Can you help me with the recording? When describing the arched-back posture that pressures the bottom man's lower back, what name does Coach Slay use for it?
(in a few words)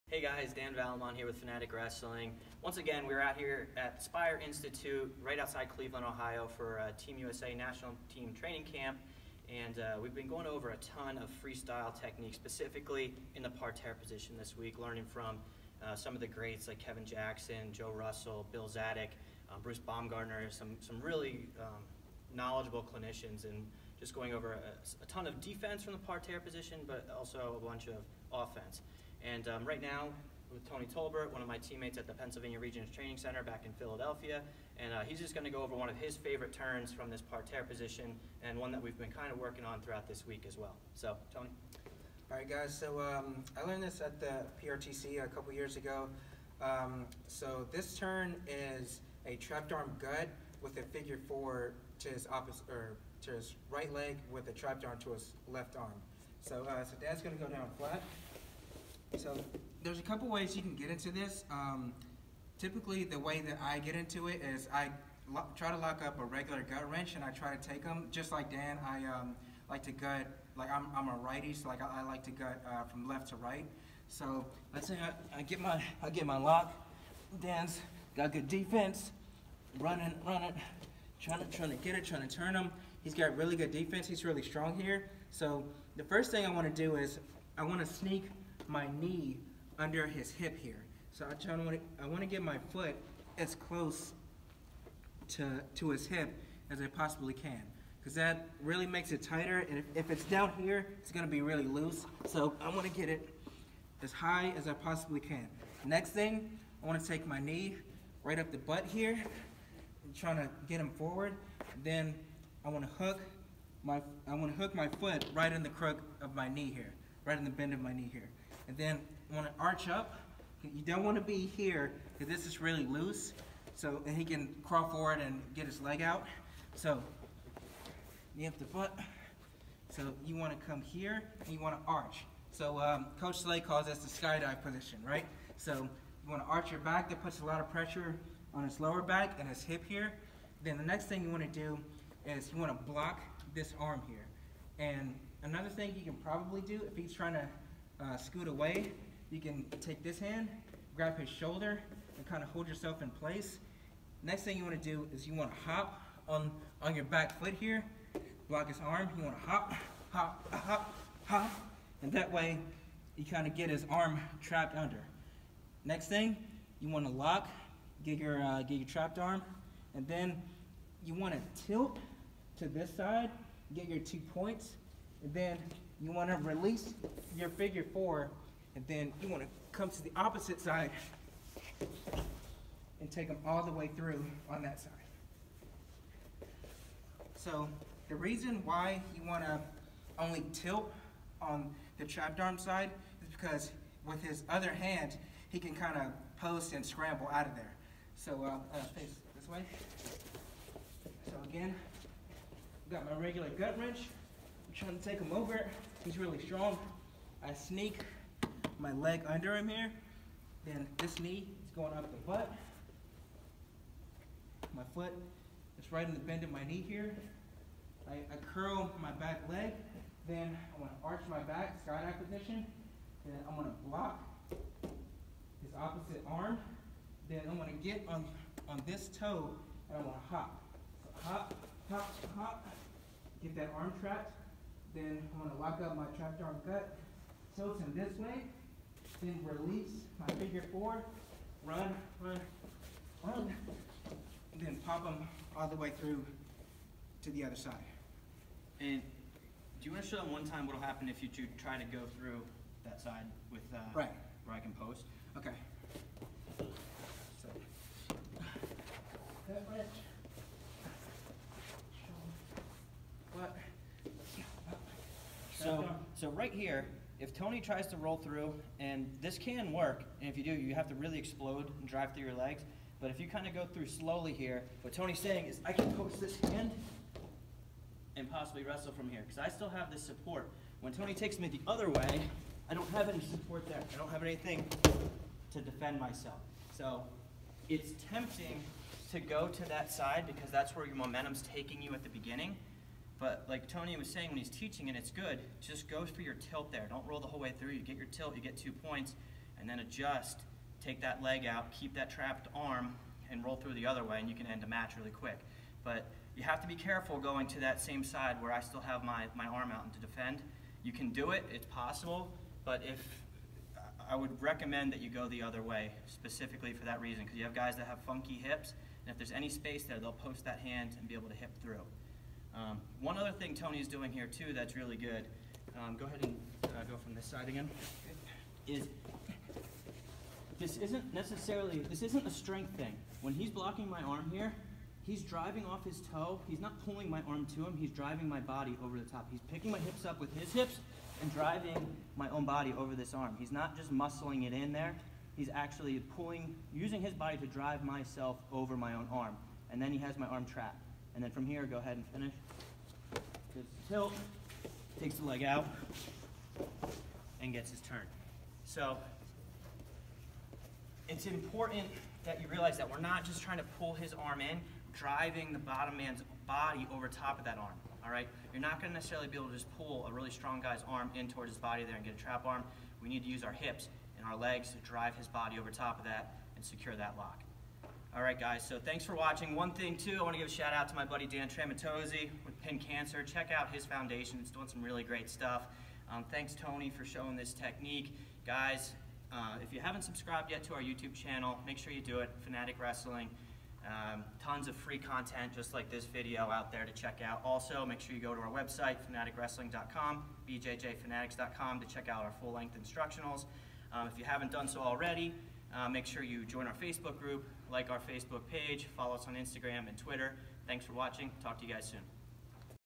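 skydive position.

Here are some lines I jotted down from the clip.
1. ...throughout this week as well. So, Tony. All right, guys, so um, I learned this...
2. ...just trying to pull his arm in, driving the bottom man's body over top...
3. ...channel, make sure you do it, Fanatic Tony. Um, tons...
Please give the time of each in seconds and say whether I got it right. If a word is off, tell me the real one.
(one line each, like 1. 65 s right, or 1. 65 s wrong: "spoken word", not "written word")
1. 39 s right
2. 363 s right
3. 391 s wrong: "Wrestling", not "Tony".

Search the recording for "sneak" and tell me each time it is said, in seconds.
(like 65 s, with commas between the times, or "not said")
87 s, 207 s.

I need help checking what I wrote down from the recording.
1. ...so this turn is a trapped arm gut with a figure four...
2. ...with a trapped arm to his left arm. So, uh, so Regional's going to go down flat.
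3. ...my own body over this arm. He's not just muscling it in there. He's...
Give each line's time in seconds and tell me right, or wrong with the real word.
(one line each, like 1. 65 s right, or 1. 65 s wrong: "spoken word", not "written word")
1. 47 s right
2. 54 s wrong: "Dan", not "Regional"
3. 342 s right.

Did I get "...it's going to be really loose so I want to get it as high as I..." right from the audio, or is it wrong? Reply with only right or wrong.
right.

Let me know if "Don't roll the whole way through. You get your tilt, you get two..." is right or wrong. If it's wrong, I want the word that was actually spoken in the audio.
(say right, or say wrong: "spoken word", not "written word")
right.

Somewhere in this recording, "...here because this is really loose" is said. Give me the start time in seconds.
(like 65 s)
121 s.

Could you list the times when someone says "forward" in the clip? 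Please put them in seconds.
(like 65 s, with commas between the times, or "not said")
110 s, 124 s.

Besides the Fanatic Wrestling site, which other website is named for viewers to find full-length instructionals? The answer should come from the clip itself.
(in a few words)
bjjfanatics.com.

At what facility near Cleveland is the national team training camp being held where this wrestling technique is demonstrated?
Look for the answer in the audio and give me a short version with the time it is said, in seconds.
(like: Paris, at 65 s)
Spire Institute, at 4 s.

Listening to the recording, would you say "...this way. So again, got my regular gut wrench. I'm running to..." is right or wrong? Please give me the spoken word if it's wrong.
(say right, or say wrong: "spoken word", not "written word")
wrong: "trying", not "running".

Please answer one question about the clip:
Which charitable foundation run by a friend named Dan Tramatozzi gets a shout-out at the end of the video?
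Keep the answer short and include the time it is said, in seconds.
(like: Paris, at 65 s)
Pin Cancer, at 382 s.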